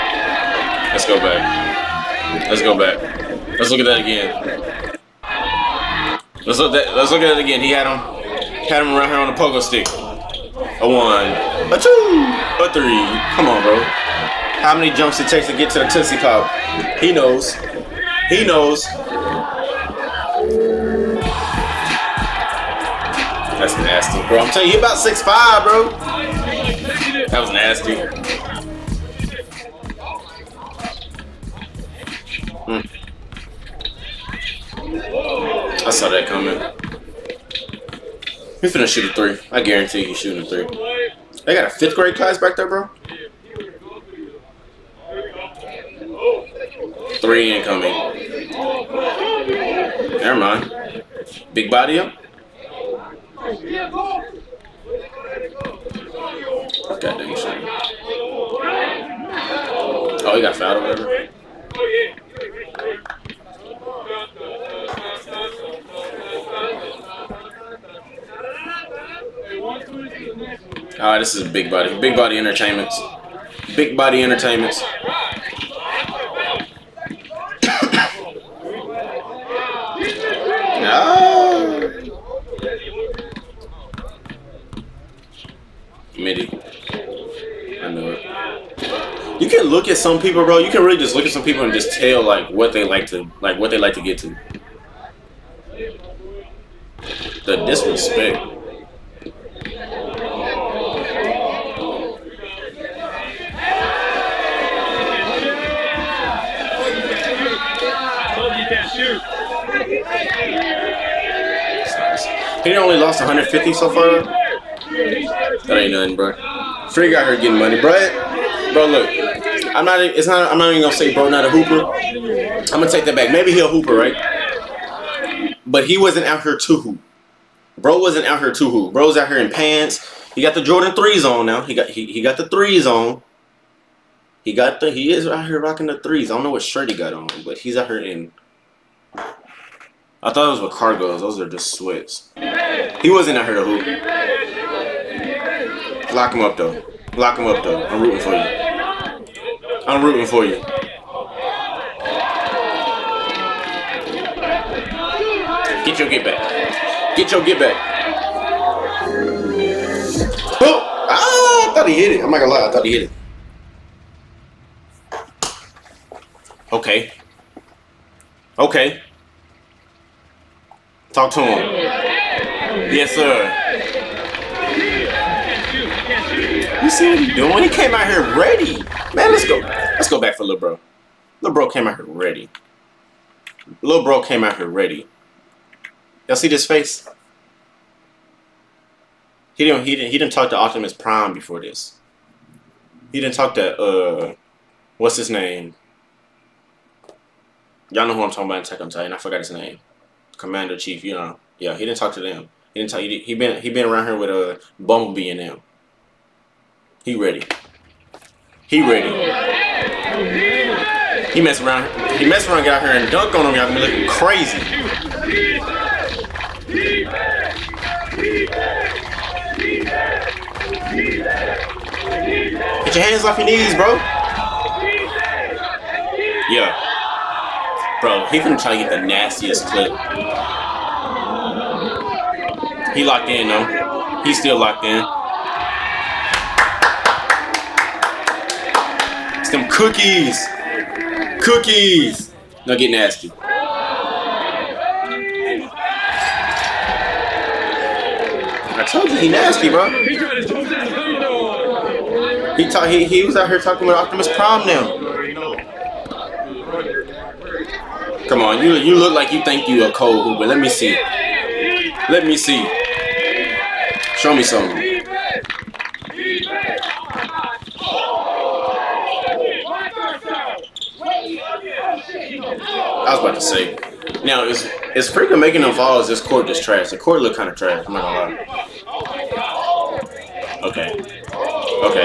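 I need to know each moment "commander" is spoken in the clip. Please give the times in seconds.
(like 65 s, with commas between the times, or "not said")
200 s.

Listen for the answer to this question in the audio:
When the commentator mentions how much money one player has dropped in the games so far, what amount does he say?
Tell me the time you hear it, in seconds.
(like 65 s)
113 s.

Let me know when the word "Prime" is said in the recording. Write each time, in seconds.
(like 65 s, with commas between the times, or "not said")
190 s, 254 s.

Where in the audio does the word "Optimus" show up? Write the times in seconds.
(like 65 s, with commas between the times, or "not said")
190 s, 254 s.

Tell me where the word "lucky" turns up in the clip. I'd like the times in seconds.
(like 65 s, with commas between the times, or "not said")
not said.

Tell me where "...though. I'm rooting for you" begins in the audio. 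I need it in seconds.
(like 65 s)
147 s.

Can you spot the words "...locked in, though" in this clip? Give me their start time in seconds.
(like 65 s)
233 s.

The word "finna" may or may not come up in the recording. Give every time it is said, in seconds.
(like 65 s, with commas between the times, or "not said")
38 s.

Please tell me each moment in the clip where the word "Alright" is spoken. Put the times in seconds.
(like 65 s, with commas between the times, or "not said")
71 s.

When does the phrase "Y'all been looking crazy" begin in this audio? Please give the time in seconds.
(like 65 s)
213 s.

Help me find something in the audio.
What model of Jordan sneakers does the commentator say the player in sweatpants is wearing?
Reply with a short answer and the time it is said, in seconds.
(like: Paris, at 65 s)
Jordan threes, at 130 s.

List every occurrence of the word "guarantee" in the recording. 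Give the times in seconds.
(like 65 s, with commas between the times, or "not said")
39 s.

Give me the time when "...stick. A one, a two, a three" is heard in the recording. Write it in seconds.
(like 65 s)
9 s.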